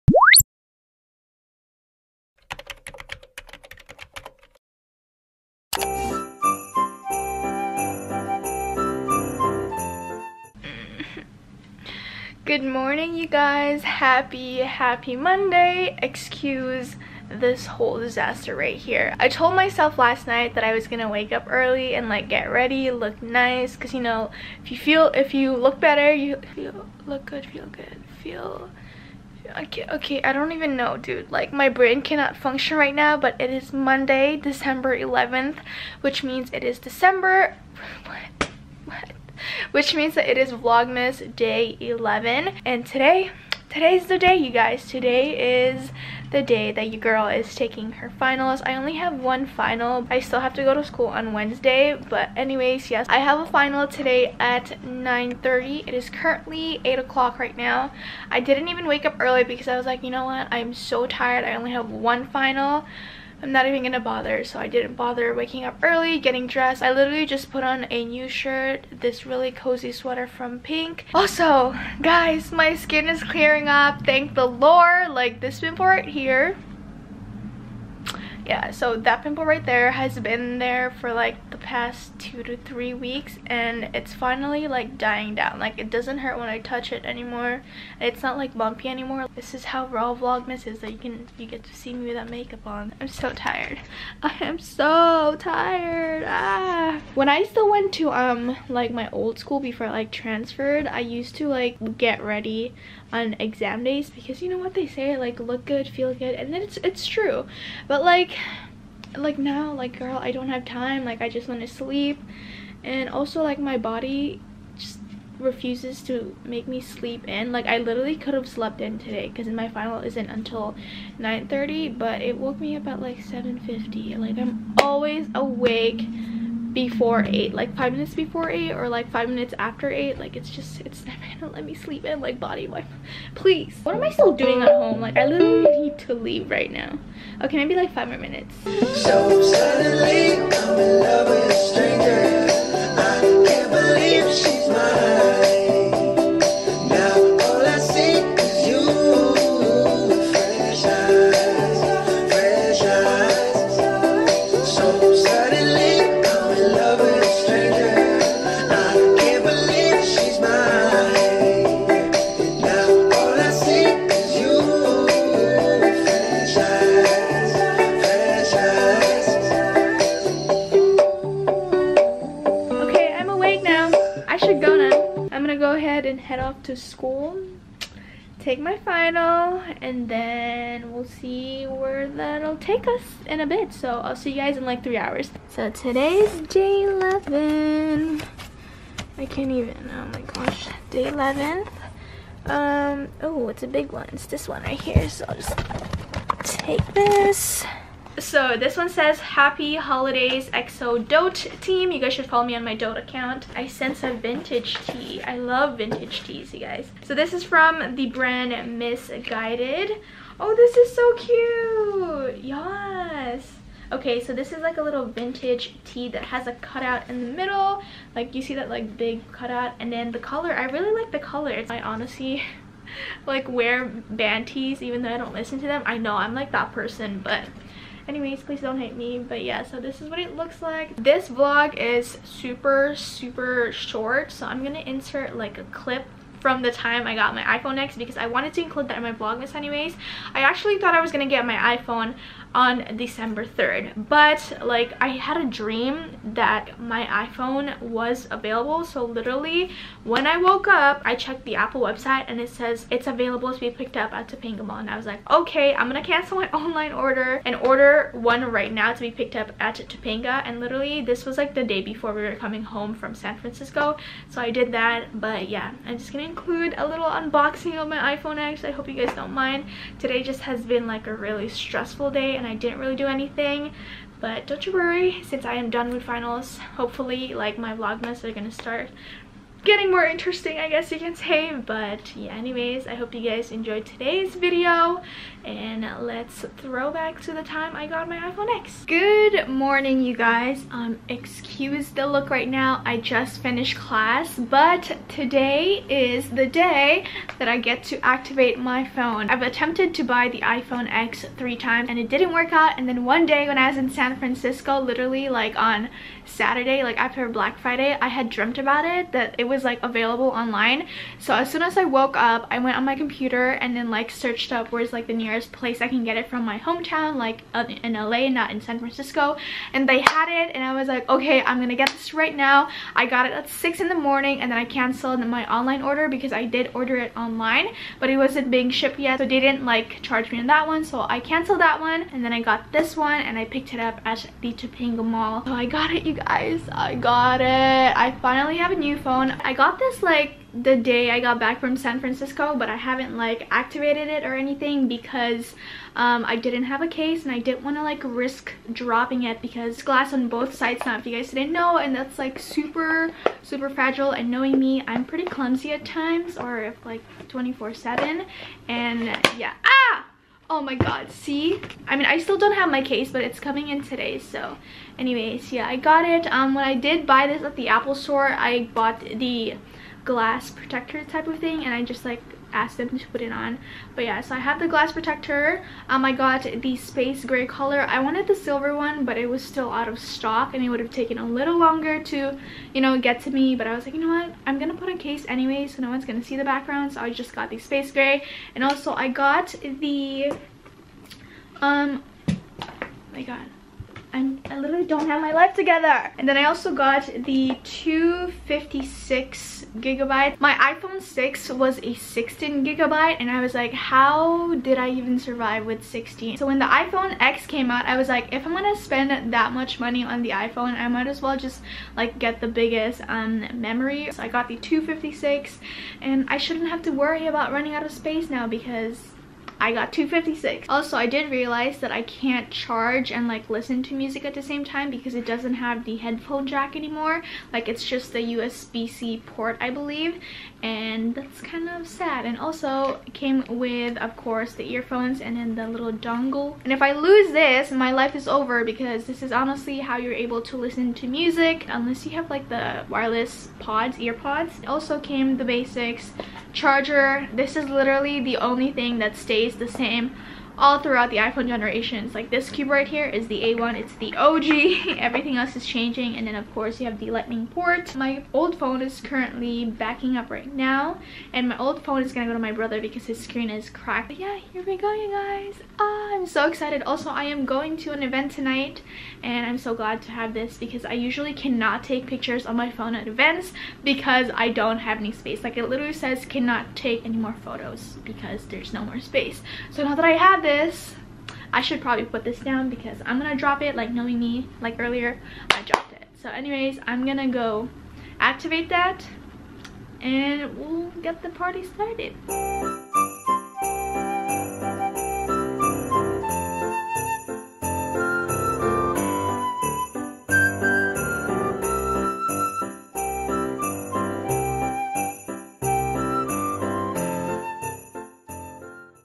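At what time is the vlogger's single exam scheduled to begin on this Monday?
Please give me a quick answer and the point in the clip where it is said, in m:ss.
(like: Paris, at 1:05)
9:30, at 0:54.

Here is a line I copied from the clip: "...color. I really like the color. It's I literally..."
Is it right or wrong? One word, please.
wrong.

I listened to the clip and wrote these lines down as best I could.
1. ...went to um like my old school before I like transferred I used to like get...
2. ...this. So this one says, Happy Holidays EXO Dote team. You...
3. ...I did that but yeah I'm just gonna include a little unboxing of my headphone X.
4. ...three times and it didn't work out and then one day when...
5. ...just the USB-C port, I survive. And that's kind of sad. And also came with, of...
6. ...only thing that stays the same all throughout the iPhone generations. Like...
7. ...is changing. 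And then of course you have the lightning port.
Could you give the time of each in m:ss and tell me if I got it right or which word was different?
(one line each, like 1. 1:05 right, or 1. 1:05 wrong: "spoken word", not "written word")
1. 1:37 right
2. 3:16 right
3. 4:24 wrong: "iPhone", not "headphone"
4. 5:01 right
5. 7:07 wrong: "believe", not "survive"
6. 7:28 right
7. 7:35 right.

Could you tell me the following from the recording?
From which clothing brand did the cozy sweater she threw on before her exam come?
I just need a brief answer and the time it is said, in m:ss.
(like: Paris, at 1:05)
Pink, at 1:10.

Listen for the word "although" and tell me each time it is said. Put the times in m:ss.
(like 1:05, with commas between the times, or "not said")
not said.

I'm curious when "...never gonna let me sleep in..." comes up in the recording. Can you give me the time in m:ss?
2:11.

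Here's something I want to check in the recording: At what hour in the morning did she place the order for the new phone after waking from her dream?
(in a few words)
6.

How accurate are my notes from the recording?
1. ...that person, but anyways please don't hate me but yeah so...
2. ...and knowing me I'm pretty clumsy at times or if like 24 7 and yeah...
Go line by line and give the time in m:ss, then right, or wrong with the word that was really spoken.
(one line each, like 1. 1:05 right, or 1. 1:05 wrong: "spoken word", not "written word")
1. 3:46 right
2. 5:54 right.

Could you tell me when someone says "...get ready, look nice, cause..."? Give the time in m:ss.
0:22.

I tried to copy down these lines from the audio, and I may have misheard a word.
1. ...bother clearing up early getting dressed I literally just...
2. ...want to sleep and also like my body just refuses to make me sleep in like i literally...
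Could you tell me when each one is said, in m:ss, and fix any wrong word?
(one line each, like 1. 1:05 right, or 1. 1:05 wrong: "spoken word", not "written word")
1. 1:04 wrong: "waking", not "clearing"
2. 1:51 right.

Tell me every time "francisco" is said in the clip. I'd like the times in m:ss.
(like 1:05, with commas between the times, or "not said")
4:23, 5:04, 5:18, 5:41.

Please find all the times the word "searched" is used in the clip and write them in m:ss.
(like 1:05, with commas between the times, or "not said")
5:14.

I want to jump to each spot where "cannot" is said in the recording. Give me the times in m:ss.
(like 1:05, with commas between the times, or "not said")
0:32, 7:51, 7:56.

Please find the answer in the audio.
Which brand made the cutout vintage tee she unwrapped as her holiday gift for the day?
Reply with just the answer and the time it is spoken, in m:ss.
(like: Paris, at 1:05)
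Missguided, at 3:28.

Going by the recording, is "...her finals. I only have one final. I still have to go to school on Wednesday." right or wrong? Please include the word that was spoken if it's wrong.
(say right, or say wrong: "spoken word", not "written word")
right.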